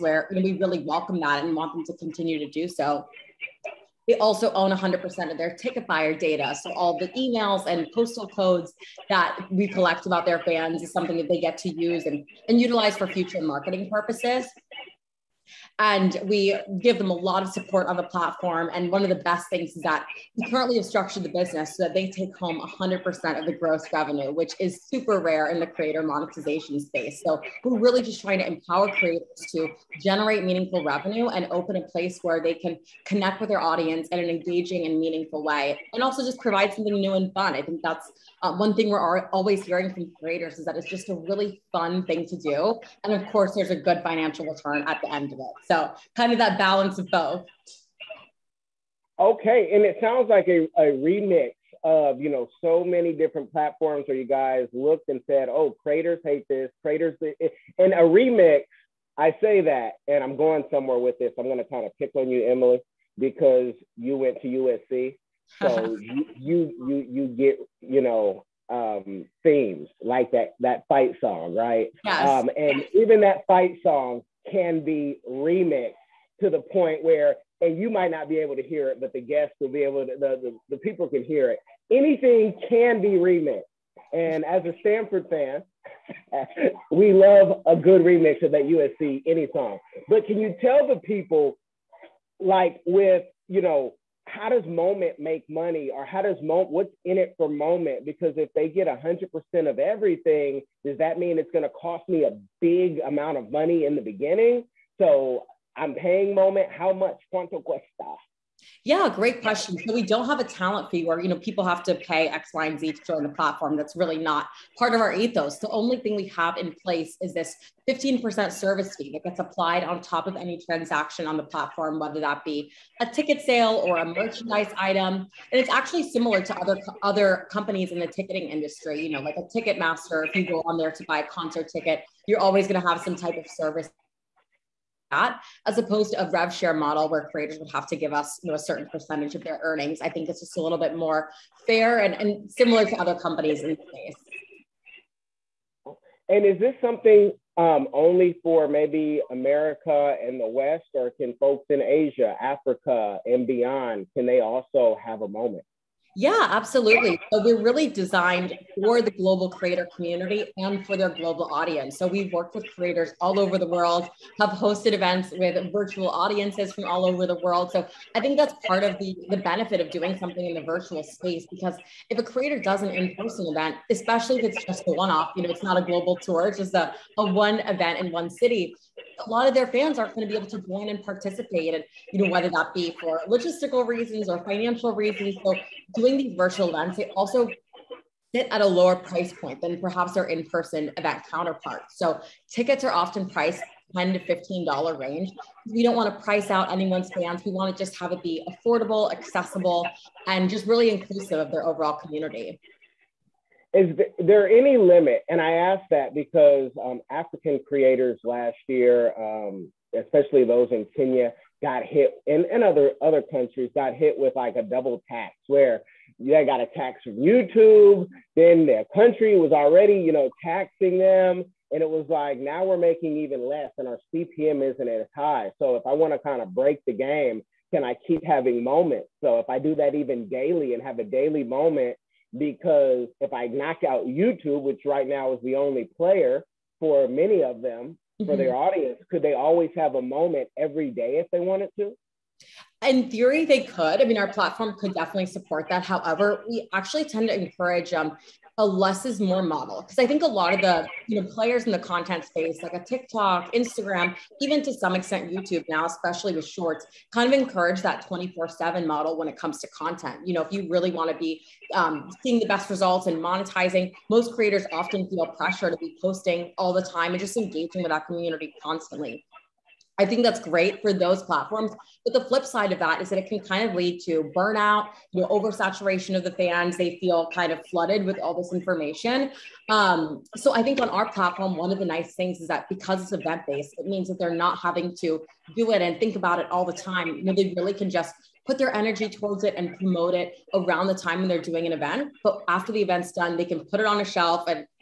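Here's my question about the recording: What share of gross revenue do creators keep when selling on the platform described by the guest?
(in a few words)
100%.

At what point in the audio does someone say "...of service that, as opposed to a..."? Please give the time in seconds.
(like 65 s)
133 s.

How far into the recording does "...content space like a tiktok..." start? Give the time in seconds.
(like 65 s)
251 s.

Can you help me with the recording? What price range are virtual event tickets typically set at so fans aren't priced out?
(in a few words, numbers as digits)
$10 to $15.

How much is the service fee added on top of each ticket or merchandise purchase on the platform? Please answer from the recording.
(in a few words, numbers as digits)
15%.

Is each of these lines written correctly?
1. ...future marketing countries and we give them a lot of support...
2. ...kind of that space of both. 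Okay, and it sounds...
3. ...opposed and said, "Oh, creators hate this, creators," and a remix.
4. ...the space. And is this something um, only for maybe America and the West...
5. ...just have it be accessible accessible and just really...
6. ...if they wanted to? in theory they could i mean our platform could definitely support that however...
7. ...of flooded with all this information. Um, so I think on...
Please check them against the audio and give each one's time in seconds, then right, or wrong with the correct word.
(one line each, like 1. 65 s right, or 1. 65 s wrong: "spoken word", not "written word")
1. 13 s wrong: "purposes", not "countries"
2. 46 s wrong: "balance", not "space"
3. 54 s wrong: "looked", not "opposed"
4. 143 s right
5. 197 s wrong: "affordable", not "accessible"
6. 241 s right
7. 277 s right.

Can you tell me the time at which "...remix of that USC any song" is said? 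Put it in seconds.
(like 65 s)
88 s.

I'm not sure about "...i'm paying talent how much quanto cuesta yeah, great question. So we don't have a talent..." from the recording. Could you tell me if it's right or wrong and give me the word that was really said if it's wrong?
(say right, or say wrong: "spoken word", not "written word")
wrong: "moment", not "talent".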